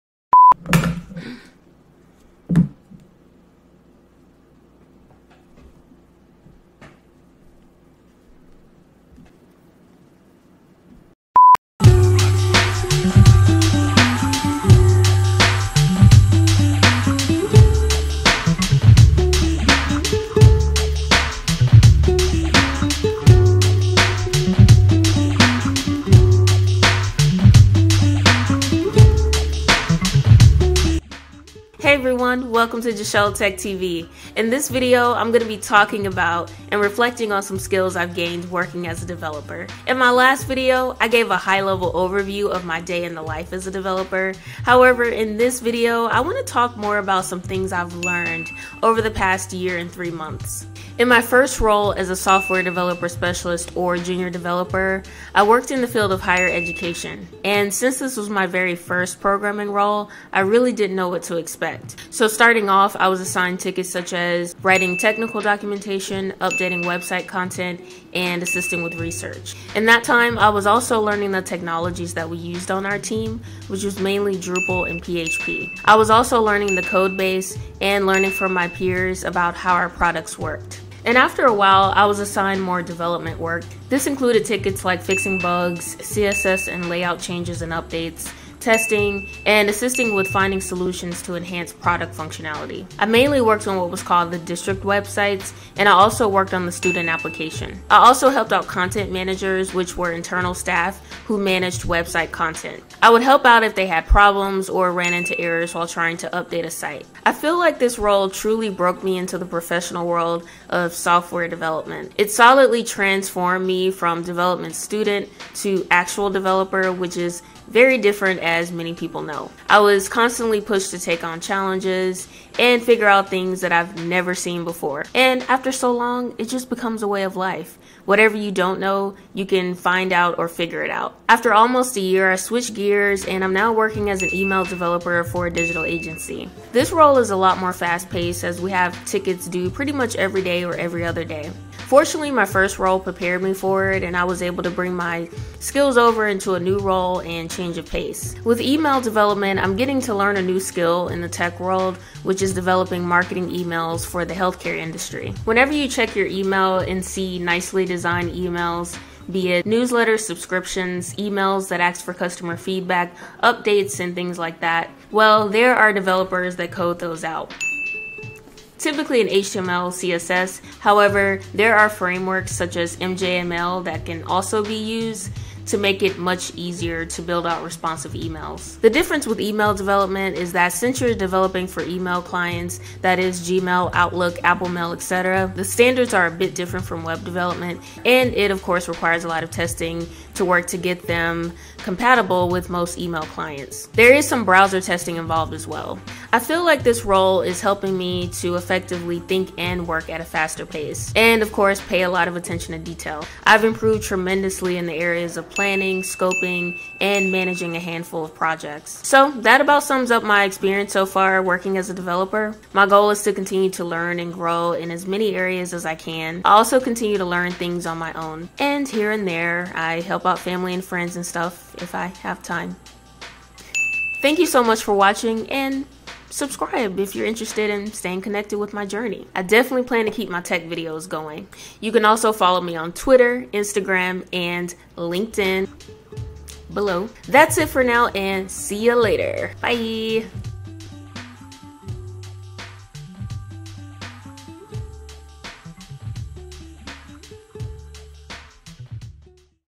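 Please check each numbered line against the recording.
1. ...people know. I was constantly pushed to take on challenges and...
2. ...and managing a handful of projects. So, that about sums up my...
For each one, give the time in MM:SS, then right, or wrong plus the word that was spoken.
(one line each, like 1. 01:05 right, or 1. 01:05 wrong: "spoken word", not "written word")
1. 01:58 right
2. 03:27 right.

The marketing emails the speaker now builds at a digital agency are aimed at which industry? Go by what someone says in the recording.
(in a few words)
healthcare.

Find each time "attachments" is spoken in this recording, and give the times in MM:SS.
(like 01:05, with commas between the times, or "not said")
not said.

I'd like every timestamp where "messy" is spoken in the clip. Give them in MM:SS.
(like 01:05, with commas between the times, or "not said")
not said.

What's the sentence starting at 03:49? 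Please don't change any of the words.
I definitely plan to keep my tech videos going.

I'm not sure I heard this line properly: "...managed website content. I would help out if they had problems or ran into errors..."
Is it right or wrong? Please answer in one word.
right.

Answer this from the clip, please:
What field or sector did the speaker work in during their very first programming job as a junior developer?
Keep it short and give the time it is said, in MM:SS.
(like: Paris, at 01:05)
higher education, at 00:56.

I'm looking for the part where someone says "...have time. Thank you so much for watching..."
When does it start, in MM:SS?
03:42.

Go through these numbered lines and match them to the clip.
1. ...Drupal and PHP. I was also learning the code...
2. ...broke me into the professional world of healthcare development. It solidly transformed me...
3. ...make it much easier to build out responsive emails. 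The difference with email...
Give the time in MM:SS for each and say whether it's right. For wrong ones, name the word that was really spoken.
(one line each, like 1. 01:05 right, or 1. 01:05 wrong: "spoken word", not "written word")
1. 01:14 right
2. 01:48 wrong: "software", not "healthcare"
3. 02:55 right.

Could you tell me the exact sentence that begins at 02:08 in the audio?
Whatever you don't know, you can find out or figure it out.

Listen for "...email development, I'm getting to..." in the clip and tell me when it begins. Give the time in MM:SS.
02:28.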